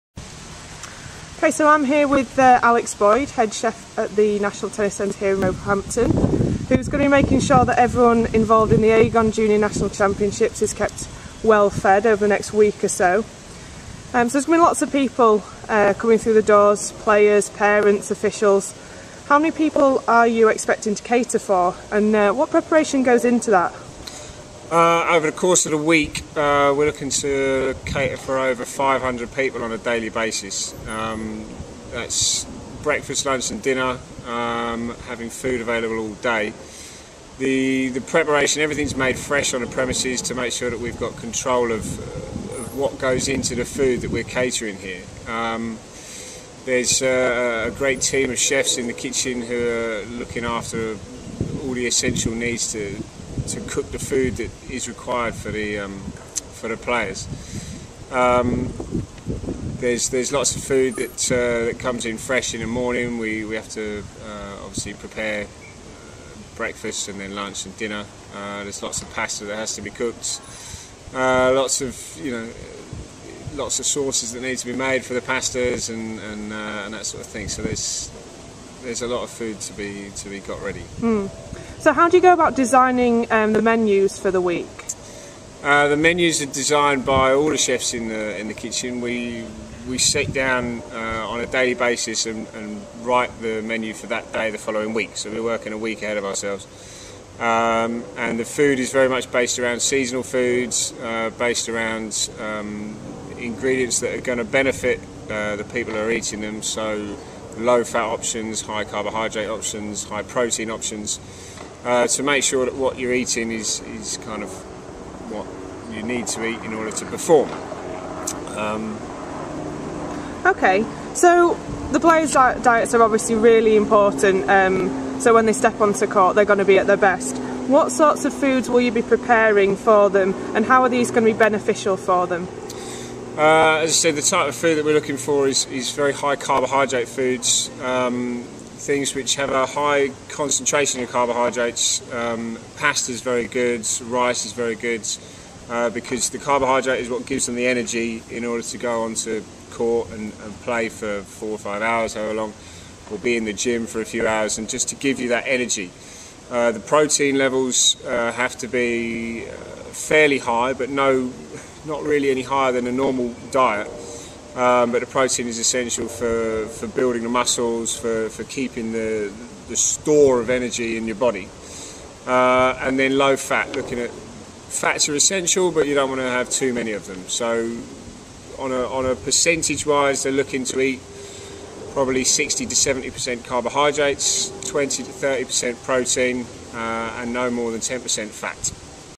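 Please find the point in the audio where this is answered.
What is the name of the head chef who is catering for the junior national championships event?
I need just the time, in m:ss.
0:02.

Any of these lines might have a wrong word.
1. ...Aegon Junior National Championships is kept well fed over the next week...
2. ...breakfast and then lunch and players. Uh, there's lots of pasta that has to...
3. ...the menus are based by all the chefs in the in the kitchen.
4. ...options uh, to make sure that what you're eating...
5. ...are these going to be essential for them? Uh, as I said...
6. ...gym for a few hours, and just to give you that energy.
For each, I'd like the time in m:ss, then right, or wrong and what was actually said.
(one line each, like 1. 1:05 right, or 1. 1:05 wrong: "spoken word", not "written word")
1. 0:08 right
2. 1:06 wrong: "dinner", not "players"
3. 1:25 wrong: "designed", not "based"
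4. 1:50 right
5. 2:10 wrong: "beneficial", not "essential"
6. 2:33 right.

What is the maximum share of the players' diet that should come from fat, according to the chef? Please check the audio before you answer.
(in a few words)
10%.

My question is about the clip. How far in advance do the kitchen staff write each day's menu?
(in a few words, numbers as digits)
a week.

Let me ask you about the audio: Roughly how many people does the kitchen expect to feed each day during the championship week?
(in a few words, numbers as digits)
over 500.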